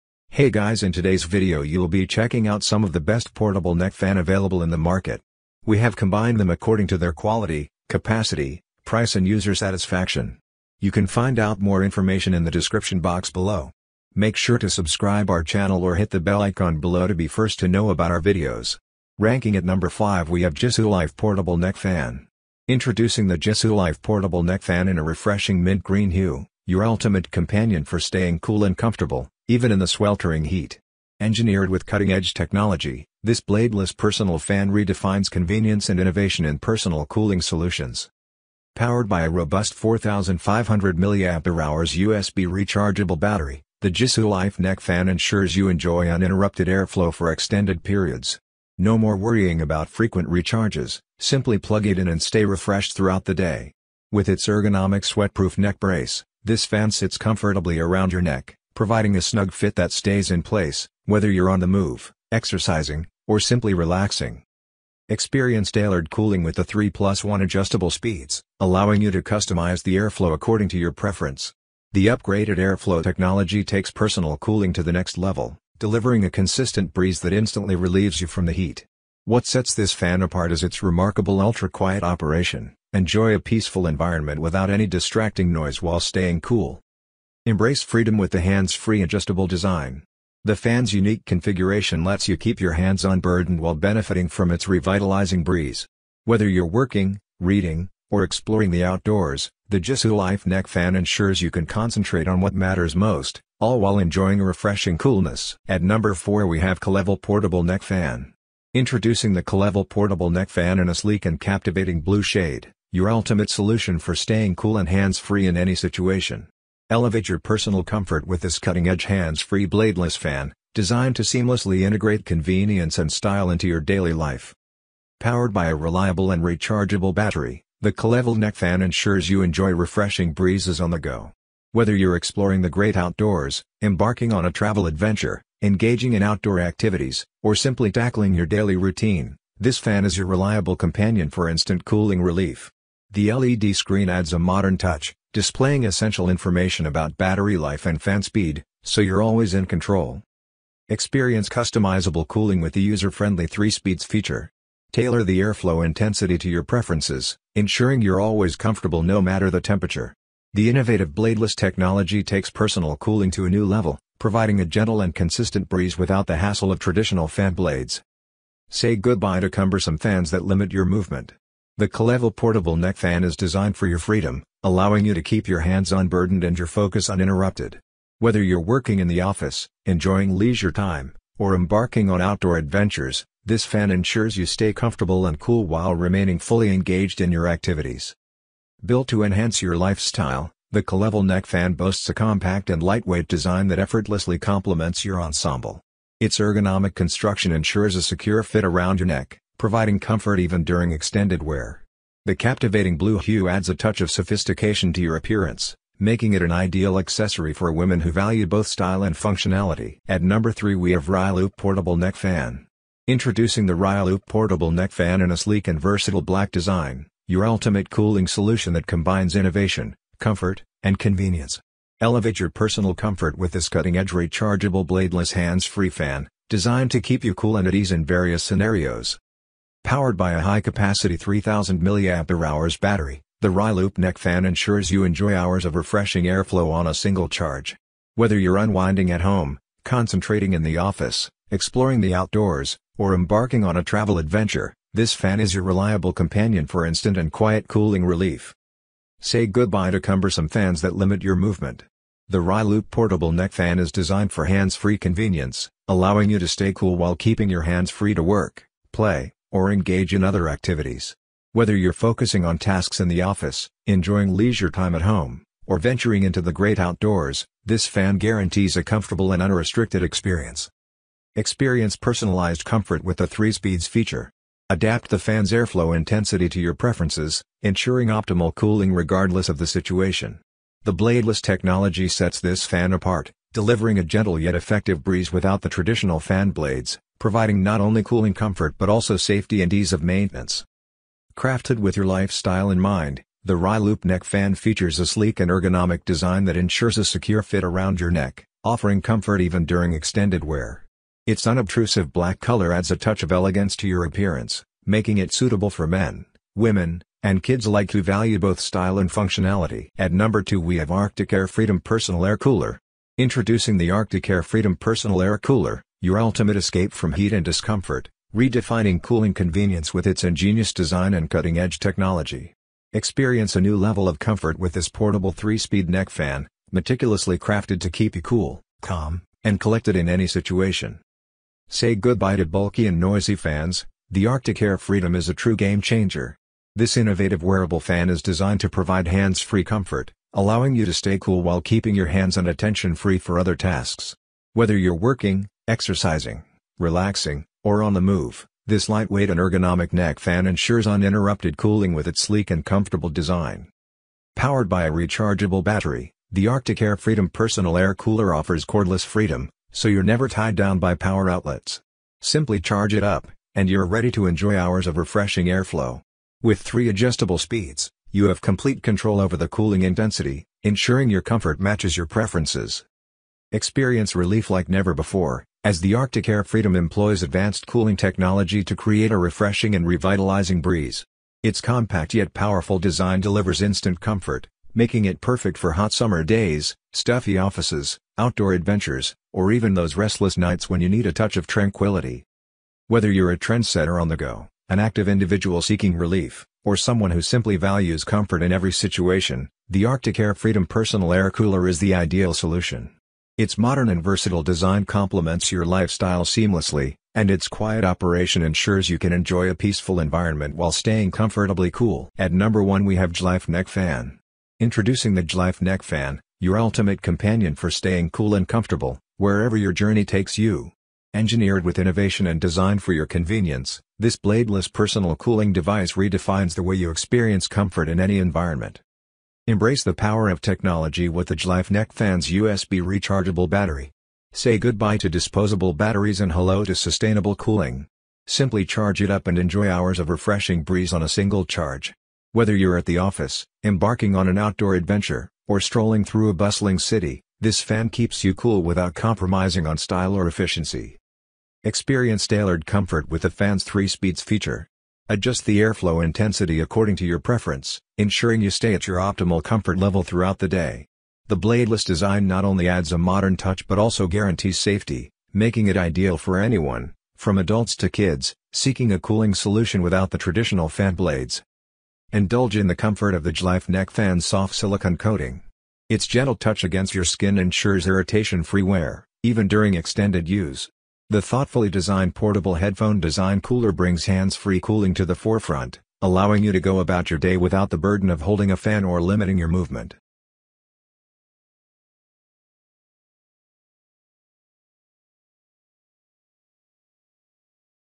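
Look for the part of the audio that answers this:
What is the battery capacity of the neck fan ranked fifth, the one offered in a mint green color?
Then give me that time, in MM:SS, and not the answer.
00:39.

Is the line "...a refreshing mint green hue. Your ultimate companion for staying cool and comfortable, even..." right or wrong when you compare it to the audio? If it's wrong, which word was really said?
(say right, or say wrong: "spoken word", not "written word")
right.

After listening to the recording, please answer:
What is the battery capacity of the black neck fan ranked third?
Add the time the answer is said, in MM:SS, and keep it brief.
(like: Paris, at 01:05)
3000 mAh, at 03:51.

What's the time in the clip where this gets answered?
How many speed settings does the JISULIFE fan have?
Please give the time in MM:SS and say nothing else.
01:06.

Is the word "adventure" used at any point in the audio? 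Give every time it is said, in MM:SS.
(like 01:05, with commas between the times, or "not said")
02:14, 03:02, 04:04, 06:28, 07:24.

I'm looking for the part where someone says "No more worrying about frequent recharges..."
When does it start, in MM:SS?
00:48.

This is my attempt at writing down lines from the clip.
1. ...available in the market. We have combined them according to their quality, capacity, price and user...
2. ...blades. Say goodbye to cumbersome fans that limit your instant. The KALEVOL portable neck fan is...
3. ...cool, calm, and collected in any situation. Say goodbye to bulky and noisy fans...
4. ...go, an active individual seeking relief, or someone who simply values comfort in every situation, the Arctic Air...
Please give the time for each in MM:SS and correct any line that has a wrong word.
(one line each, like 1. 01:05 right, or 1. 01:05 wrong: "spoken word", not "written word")
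1. 00:04 right
2. 02:47 wrong: "movement", not "instant"
3. 05:28 right
4. 06:34 right.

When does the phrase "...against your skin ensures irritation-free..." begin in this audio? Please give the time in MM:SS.
07:56.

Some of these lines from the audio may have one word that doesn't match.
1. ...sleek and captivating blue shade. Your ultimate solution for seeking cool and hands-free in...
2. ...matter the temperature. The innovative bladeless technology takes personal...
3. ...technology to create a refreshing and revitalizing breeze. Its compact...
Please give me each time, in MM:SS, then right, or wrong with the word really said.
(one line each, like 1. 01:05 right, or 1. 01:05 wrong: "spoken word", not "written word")
1. 01:50 wrong: "staying", not "seeking"
2. 02:39 right
3. 06:17 right.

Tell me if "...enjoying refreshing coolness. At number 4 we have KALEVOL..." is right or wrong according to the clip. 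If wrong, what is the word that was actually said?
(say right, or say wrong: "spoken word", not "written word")
right.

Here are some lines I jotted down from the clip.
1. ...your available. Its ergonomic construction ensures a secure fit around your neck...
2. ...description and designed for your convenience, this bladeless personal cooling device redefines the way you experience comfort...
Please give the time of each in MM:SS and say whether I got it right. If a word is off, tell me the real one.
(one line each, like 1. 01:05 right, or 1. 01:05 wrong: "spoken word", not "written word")
1. 03:15 wrong: "ensemble", not "available"
2. 07:01 wrong: "innovation", not "description".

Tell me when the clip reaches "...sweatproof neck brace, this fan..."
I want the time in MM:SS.
00:55.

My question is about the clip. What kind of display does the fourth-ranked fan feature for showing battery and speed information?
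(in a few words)
LED screen.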